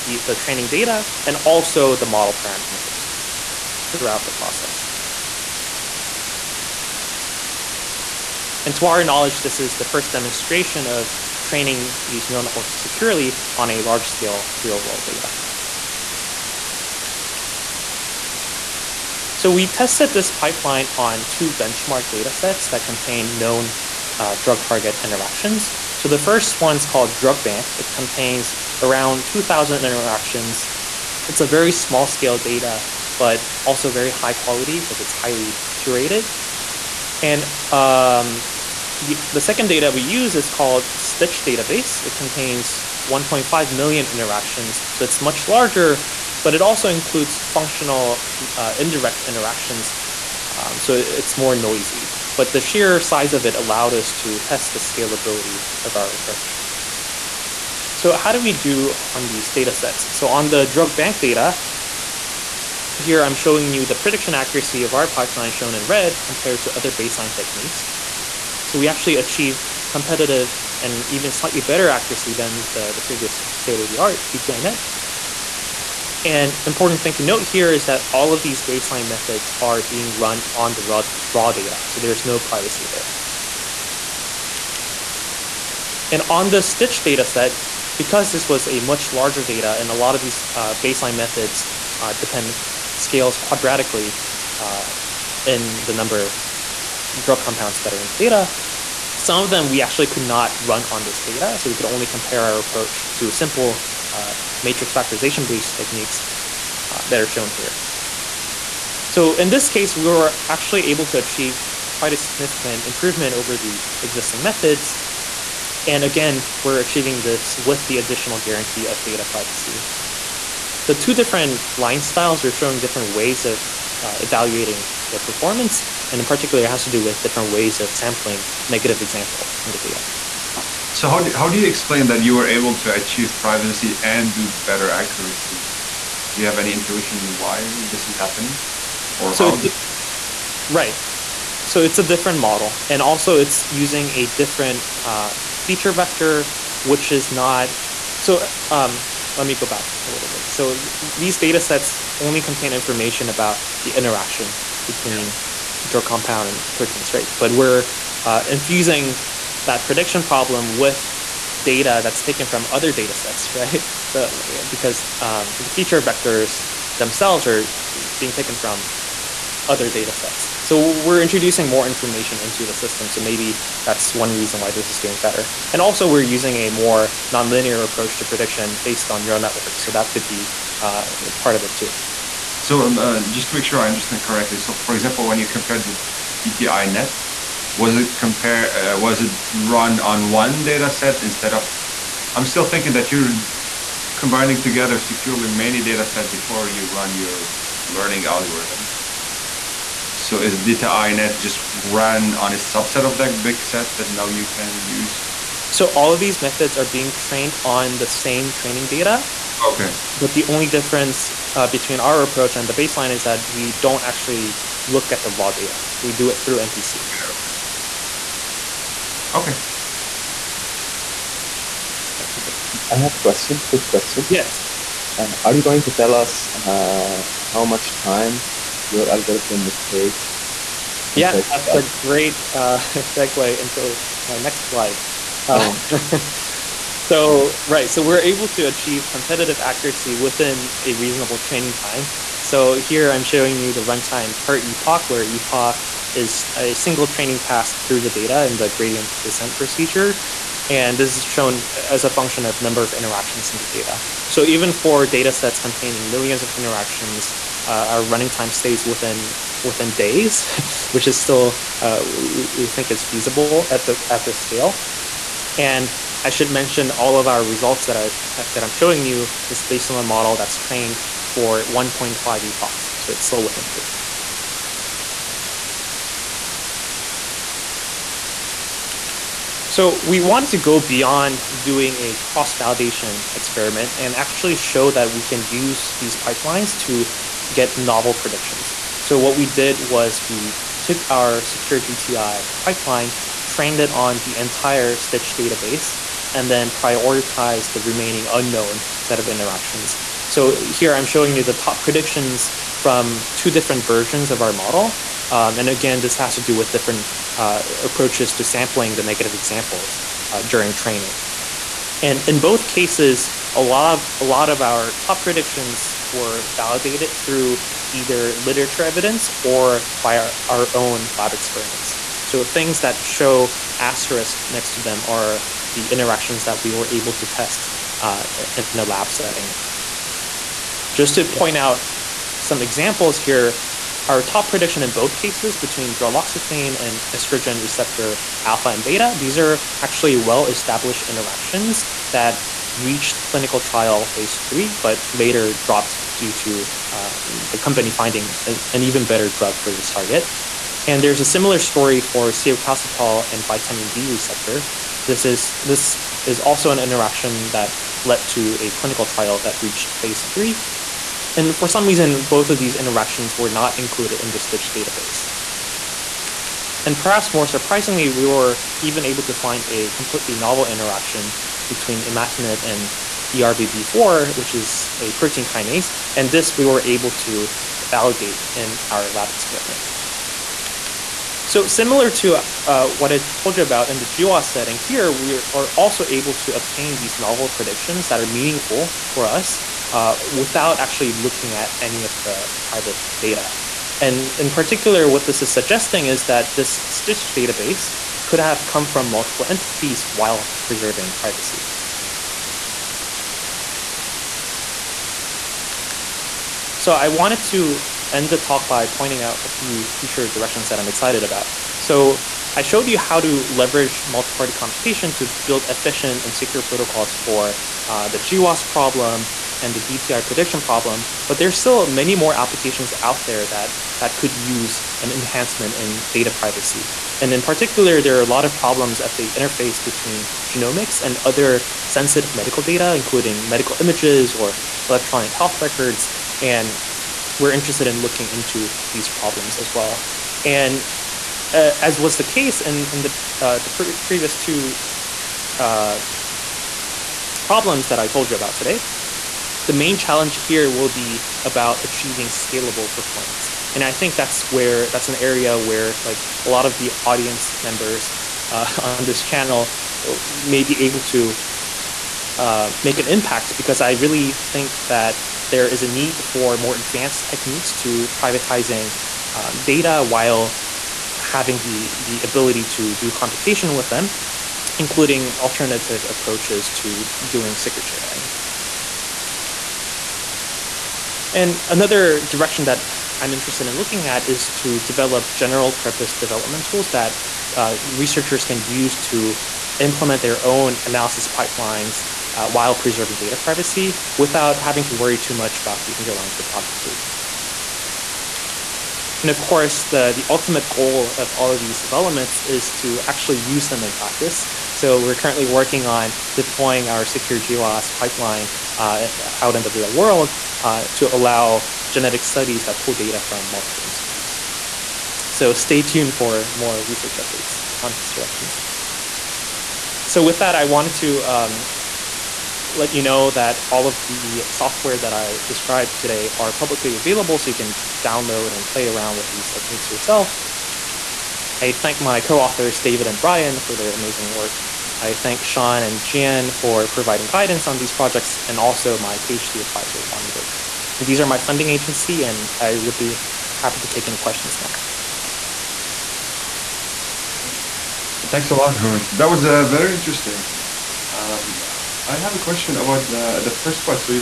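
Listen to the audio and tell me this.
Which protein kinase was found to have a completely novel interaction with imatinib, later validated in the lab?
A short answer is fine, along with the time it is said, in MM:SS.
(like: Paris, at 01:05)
ERBB4, at 06:13.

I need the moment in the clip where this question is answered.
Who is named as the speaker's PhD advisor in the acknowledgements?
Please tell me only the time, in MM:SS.
09:00.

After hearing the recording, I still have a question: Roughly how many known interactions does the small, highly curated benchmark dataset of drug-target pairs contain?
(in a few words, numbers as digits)
2,000.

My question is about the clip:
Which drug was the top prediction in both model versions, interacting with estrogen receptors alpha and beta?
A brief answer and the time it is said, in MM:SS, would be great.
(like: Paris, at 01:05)
droloxifene, at 05:35.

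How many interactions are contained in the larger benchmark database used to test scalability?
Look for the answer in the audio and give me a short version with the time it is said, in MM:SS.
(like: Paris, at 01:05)
1.5 million, at 00:43.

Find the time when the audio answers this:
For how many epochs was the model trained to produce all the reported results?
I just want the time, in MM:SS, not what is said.
04:31.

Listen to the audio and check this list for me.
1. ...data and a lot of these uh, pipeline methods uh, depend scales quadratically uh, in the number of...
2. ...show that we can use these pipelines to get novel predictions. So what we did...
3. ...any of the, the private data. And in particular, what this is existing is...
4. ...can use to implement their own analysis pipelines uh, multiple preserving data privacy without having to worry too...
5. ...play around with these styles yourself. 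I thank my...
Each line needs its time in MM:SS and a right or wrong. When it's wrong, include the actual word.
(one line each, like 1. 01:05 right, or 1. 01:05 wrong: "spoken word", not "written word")
1. 01:29 wrong: "baseline", not "pipeline"
2. 04:44 right
3. 06:31 wrong: "suggesting", not "existing"
4. 08:08 wrong: "while", not "multiple"
5. 08:48 wrong: "techniques", not "styles".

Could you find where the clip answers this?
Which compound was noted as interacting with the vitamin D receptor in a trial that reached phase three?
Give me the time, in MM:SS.
05:52.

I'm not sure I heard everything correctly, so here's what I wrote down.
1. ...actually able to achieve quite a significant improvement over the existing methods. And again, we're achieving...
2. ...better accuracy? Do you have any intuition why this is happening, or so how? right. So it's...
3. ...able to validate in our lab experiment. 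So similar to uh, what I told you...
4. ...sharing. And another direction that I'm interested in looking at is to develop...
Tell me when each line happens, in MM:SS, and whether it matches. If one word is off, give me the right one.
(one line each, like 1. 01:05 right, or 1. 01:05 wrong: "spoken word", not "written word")
1. 01:50 right
2. 02:14 right
3. 06:16 right
4. 07:57 right.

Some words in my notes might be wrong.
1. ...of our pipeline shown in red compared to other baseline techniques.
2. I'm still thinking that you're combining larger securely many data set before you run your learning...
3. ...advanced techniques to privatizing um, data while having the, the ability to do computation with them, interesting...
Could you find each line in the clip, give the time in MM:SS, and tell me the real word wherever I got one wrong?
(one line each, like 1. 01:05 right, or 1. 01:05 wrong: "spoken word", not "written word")
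1. 01:04 right
2. 03:12 wrong: "together", not "larger"
3. 07:46 wrong: "including", not "interesting".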